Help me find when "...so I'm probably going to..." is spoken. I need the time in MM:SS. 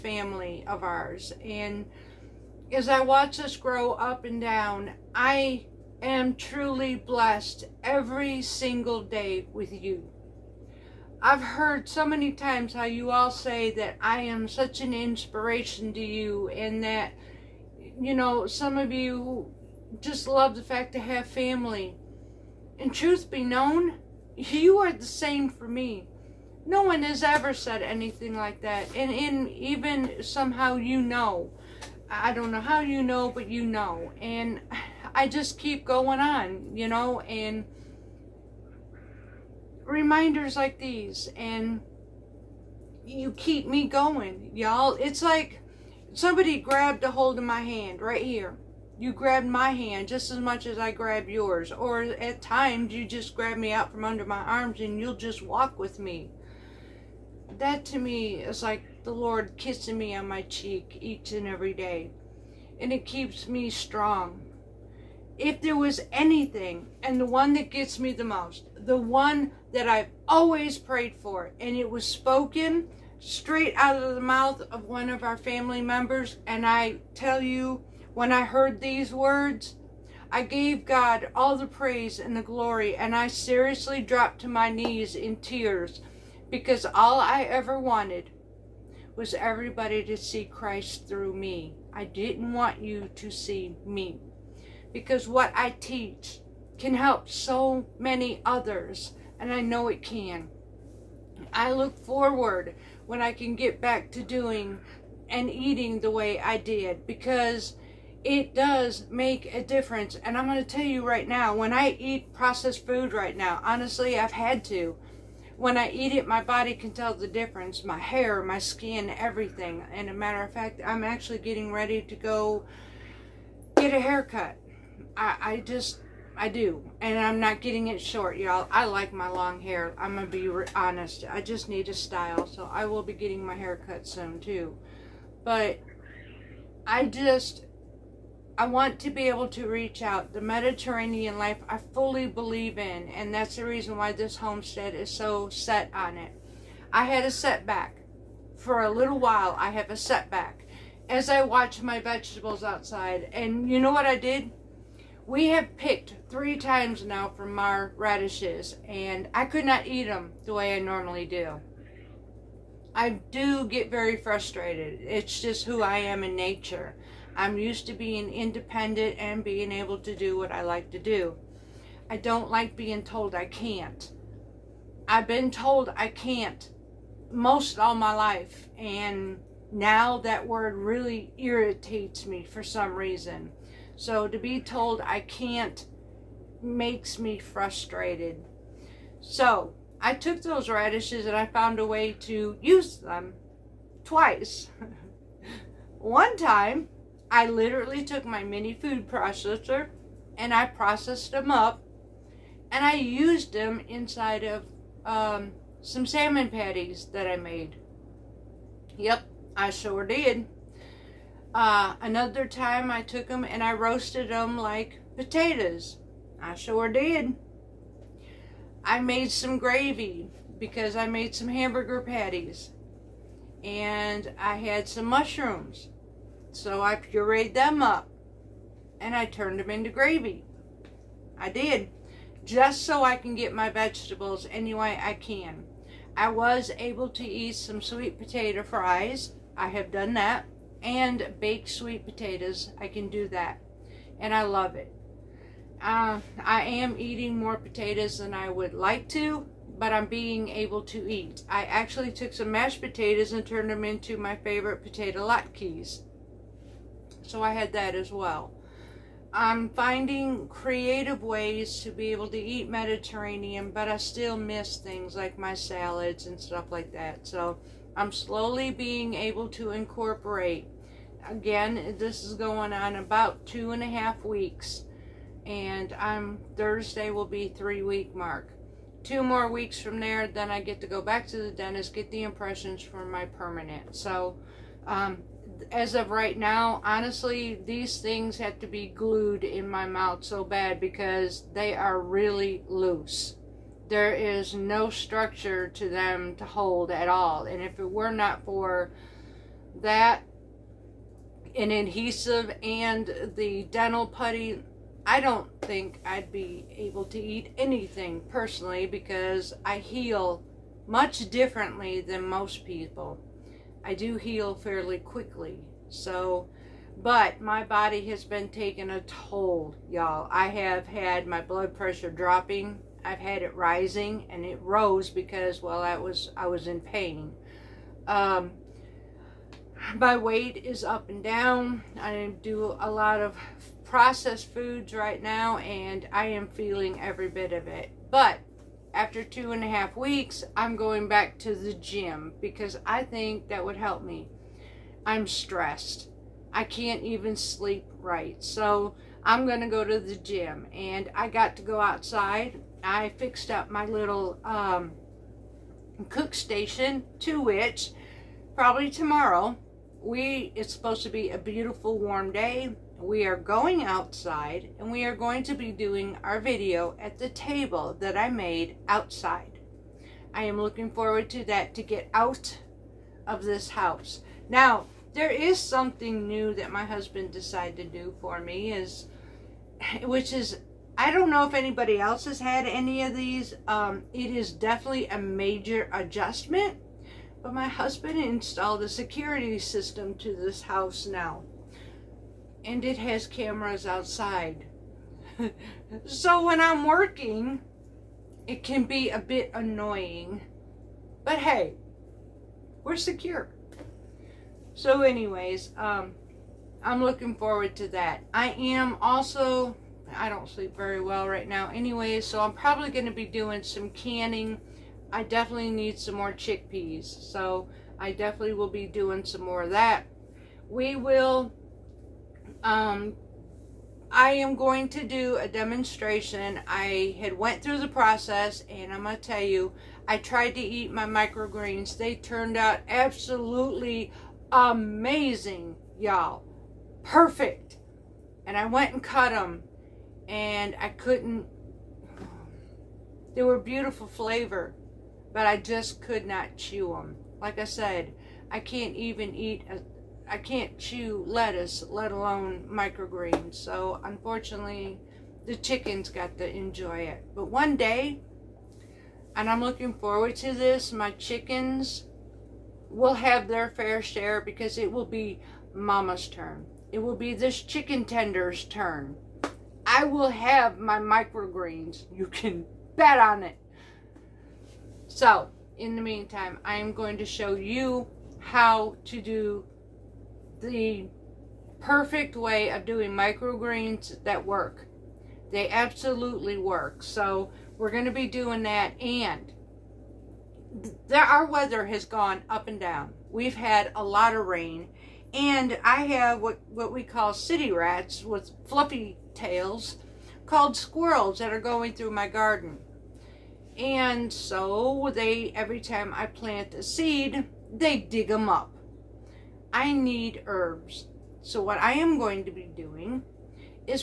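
06:52.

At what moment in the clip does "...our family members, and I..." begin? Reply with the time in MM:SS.
01:15.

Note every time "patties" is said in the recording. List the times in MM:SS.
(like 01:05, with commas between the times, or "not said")
03:26, 03:42.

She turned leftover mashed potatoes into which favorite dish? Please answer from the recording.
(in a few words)
Potato latkes.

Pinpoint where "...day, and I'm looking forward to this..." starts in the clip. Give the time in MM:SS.
07:37.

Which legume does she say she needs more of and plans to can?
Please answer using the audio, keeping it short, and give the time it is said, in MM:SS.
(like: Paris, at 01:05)
Chickpeas, at 06:56.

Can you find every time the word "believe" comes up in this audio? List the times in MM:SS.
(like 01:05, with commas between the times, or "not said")
02:22.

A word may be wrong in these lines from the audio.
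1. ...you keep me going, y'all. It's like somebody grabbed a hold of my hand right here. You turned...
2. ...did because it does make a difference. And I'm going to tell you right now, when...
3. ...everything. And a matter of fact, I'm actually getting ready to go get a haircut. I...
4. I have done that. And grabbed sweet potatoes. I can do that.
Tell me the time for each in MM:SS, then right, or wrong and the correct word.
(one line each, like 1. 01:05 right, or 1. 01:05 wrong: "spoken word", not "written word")
1. 00:43 wrong: "grabbed", not "turned"
2. 01:46 right
3. 01:59 right
4. 03:59 wrong: "baked", not "grabbed".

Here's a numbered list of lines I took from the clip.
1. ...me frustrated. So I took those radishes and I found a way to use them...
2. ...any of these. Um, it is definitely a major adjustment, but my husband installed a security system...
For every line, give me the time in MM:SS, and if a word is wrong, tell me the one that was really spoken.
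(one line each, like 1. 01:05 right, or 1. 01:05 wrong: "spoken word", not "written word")
1. 03:07 right
2. 06:22 right.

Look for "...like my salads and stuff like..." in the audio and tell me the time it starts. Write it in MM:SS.
04:25.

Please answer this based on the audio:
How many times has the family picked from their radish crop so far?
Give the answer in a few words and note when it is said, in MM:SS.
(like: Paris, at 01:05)
3, at 02:36.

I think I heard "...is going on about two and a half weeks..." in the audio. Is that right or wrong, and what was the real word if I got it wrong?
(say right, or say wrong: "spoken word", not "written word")
right.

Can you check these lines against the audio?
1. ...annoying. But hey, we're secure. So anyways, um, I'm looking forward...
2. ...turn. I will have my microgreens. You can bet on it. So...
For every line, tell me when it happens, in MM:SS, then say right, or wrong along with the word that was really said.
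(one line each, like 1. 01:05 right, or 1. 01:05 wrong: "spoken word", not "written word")
1. 06:39 right
2. 07:48 right.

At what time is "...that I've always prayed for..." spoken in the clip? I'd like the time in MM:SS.
01:09.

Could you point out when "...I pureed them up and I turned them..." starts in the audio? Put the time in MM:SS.
03:46.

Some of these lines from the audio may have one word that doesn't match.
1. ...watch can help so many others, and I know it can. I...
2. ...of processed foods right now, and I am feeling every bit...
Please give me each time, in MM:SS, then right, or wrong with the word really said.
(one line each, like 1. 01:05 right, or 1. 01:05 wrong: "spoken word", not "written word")
1. 01:35 wrong: "teach", not "watch"
2. 05:33 right.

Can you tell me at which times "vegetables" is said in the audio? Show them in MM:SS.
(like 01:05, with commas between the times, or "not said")
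02:31, 03:53.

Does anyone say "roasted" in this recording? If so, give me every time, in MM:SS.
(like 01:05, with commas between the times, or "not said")
03:33.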